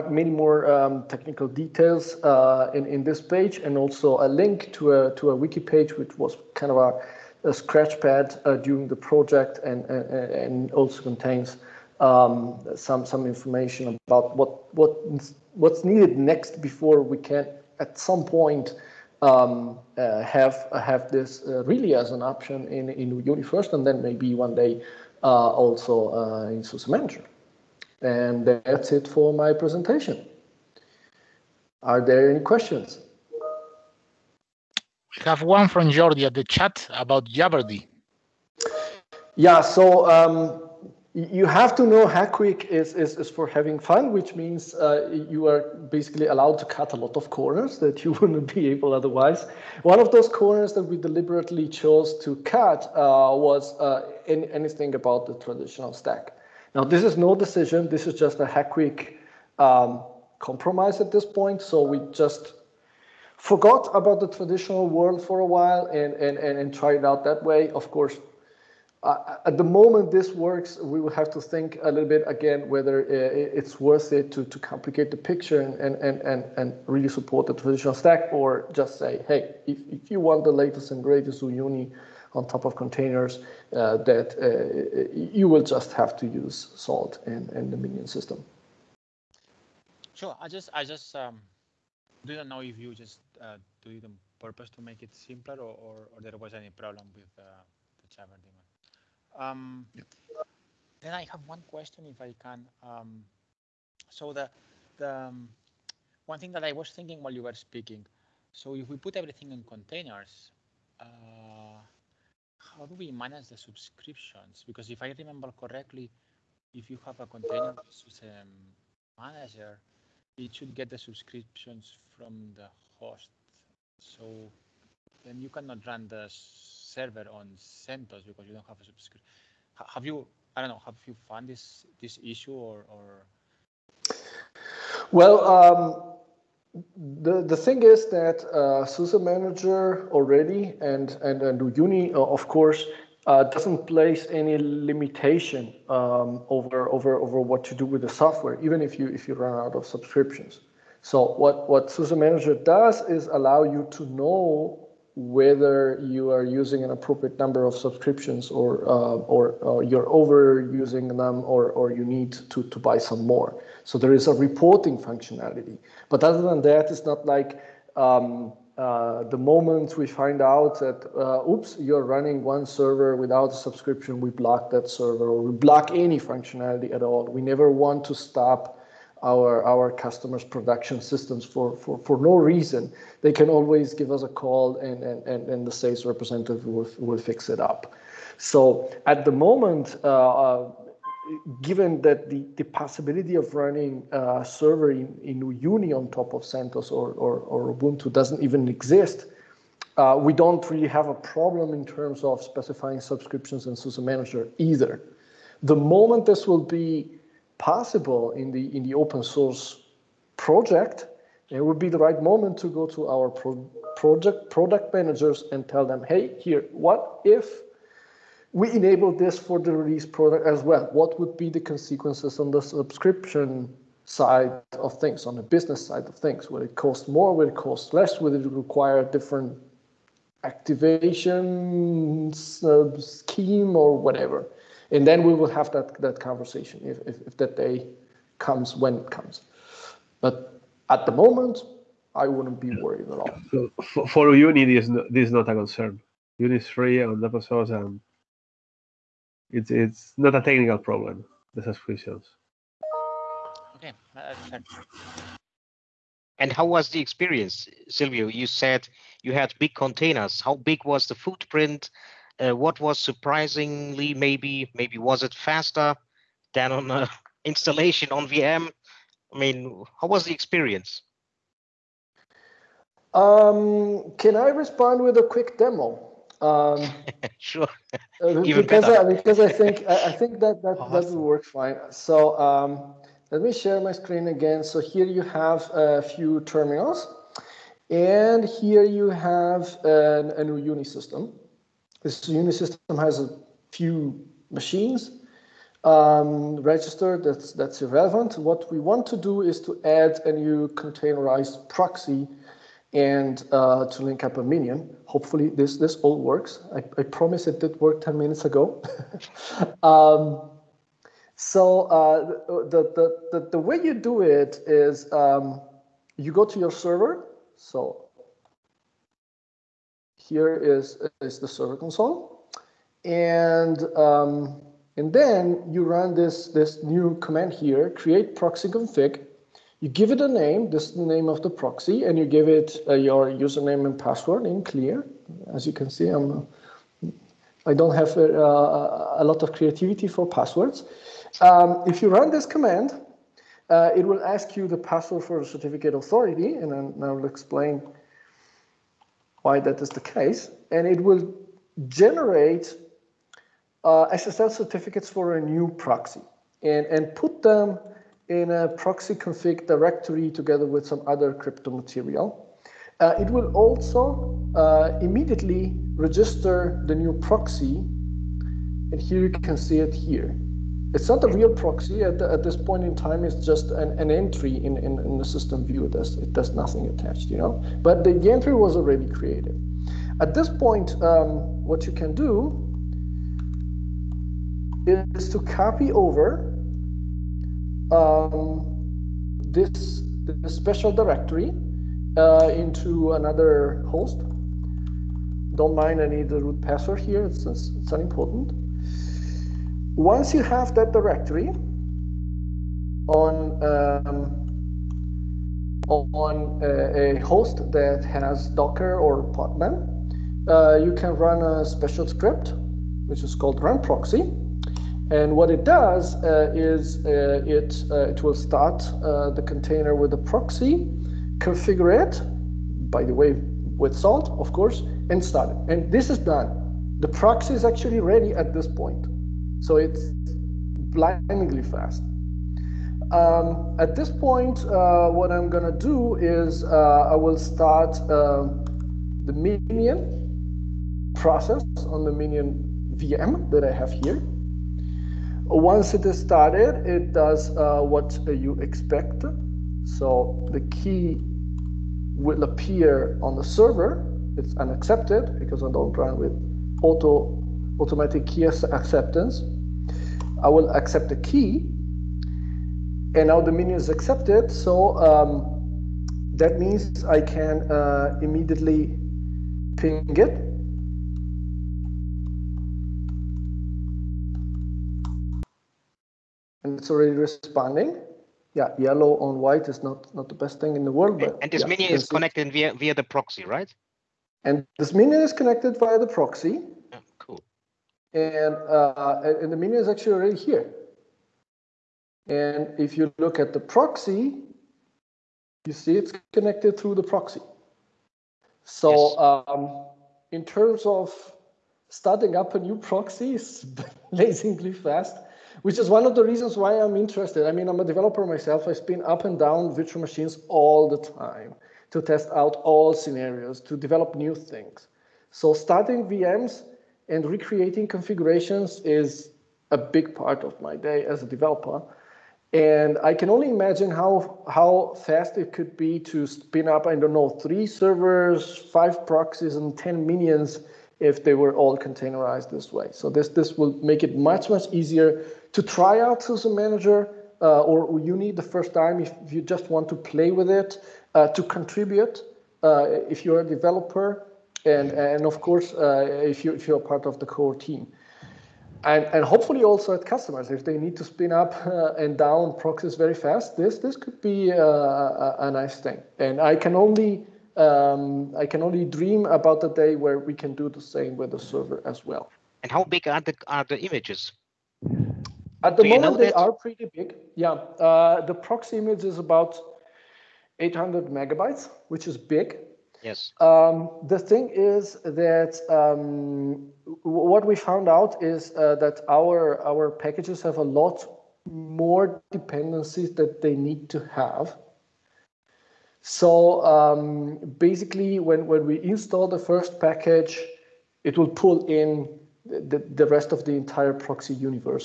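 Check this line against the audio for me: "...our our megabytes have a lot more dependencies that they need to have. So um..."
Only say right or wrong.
wrong.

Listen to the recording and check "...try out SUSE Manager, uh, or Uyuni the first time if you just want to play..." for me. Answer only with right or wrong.
right.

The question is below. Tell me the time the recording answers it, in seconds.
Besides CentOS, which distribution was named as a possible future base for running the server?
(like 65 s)
197 s.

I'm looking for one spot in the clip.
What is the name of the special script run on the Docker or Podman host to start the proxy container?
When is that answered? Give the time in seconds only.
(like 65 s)
413 s.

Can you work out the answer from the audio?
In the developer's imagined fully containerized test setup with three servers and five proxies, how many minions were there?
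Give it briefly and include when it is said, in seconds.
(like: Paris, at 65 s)
10, at 529 s.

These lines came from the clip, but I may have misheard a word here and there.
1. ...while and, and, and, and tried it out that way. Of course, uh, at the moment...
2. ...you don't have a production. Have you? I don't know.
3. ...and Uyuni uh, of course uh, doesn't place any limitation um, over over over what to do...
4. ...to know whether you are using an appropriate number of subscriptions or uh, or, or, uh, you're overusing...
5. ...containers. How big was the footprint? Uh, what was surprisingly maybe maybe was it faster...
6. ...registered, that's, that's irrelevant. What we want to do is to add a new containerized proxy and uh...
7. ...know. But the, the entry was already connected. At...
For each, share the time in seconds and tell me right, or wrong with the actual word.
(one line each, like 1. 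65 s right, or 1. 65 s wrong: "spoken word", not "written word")
1. 65 s right
2. 128 s wrong: "subscription", not "production"
3. 141 s right
4. 153 s right
5. 259 s right
6. 296 s right
7. 377 s wrong: "created", not "connected".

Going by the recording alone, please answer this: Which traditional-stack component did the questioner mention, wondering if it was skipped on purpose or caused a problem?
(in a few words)
jabberd.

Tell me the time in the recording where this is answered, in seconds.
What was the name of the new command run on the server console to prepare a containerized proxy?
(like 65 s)
327 s.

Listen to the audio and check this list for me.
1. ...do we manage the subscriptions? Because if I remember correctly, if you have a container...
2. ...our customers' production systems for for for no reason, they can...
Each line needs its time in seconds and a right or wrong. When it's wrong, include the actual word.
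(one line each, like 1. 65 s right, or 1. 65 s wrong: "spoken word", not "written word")
1. 112 s right
2. 179 s right.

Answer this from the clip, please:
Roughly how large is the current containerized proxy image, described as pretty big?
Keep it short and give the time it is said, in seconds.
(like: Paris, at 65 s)
800 megabytes, at 570 s.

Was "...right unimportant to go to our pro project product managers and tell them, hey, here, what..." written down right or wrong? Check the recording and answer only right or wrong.
wrong.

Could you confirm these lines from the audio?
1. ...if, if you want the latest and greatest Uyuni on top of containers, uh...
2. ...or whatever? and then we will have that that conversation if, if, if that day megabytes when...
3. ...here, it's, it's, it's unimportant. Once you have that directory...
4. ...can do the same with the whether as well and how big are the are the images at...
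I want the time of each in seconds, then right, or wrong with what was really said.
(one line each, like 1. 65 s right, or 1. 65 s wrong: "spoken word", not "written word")
1. 79 s right
2. 233 s wrong: "comes", not "megabytes"
3. 396 s right
4. 560 s wrong: "server", not "whether".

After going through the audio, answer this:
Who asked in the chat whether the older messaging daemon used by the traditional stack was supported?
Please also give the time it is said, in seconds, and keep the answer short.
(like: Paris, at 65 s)
Jordi, at 35 s.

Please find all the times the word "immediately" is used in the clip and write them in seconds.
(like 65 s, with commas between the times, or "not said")
364 s, 468 s.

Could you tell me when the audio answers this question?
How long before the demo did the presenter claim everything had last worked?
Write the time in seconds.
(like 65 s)
307 s.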